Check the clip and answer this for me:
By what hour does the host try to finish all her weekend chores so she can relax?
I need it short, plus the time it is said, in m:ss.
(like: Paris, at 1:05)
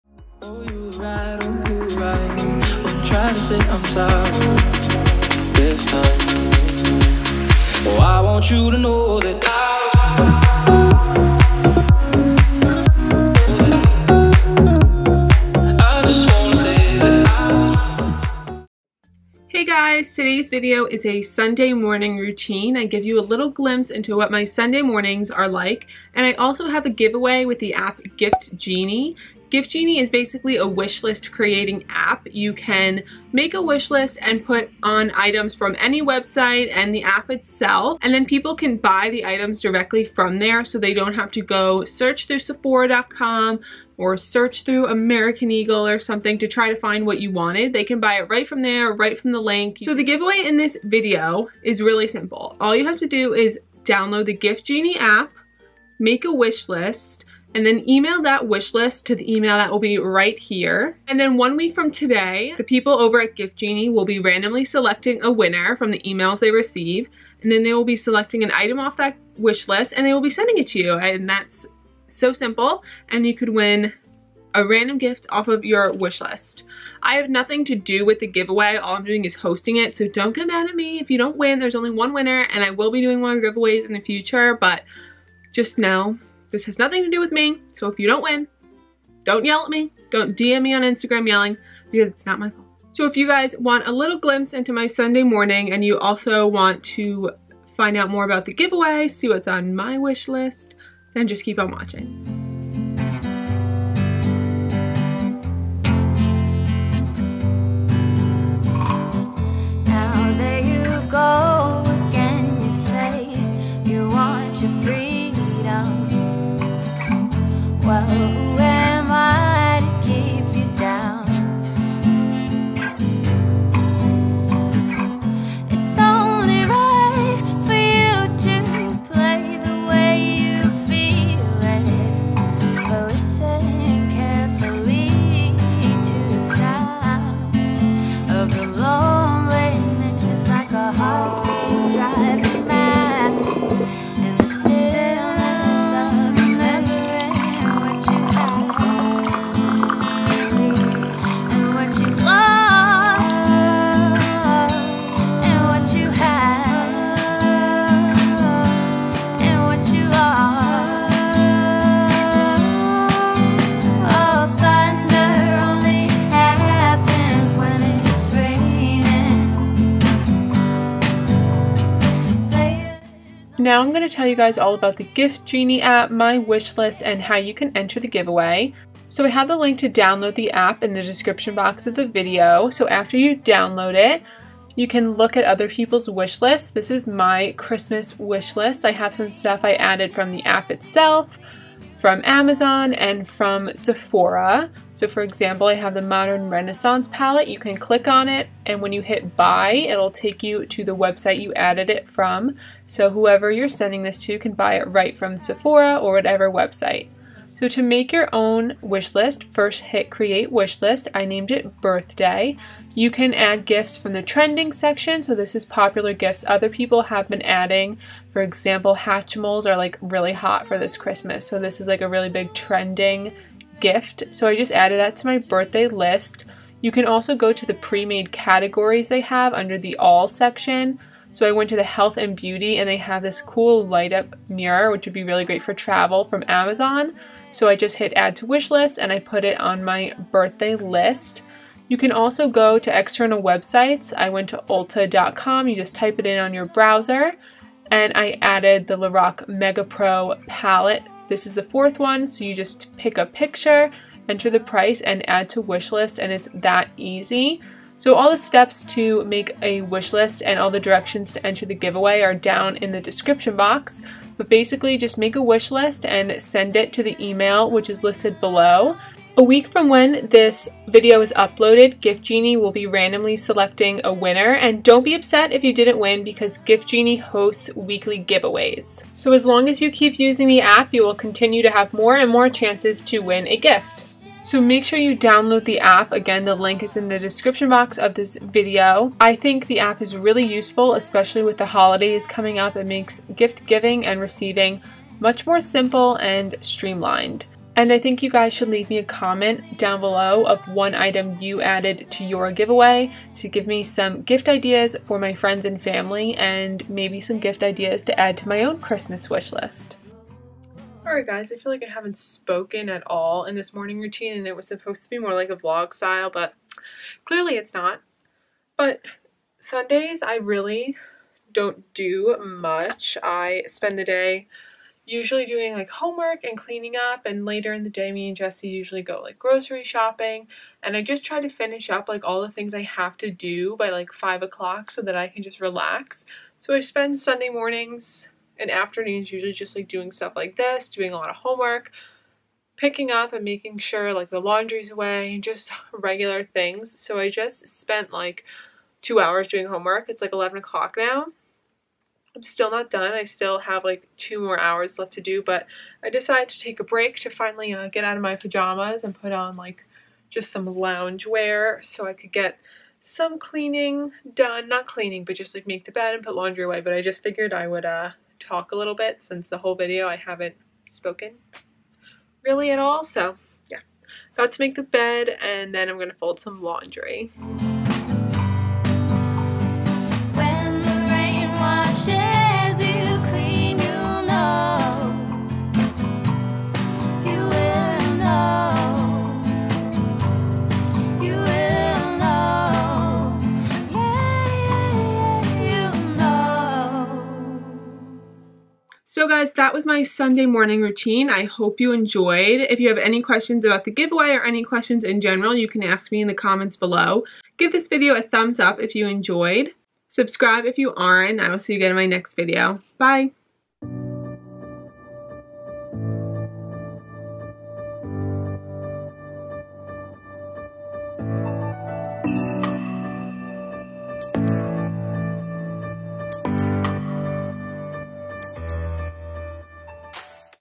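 5 o'clock, at 5:34.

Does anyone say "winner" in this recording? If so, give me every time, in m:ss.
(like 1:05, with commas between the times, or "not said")
1:05, 1:22, 4:34.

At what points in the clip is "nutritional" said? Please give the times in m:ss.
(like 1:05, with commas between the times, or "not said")
not said.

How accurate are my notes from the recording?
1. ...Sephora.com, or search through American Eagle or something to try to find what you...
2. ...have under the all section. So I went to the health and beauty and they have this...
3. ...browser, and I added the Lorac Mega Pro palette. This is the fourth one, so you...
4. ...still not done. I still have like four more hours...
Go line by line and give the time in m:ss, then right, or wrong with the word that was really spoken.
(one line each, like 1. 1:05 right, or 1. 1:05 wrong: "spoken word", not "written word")
1. 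0:42 right
2. 3:49 right
3. 4:06 right
4. 5:52 wrong: "two", not "four".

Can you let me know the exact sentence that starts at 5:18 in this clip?
But Sundays I really don't do much.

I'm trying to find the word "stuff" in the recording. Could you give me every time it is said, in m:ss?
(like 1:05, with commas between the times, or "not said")
3:09, 5:40.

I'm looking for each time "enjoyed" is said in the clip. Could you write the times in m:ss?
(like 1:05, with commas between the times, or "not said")
6:41, 6:49.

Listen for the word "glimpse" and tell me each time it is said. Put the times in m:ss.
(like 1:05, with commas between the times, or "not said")
0:23, 1:34.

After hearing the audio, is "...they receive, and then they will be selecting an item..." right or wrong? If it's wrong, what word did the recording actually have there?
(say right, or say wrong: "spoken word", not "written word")
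right.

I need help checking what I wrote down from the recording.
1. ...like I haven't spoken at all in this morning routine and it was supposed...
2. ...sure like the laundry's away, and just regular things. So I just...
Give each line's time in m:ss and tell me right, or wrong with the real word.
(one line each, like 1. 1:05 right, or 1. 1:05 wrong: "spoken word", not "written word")
1. 5:11 right
2. 5:43 right.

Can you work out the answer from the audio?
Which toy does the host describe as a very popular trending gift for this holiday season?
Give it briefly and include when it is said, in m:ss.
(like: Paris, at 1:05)
Hatchimals, at 3:38.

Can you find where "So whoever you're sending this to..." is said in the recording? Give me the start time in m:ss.
3:22.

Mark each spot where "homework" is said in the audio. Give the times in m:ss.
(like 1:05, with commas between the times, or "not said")
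5:25, 5:41, 5:49.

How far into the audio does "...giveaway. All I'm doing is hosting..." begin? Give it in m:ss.
1:18.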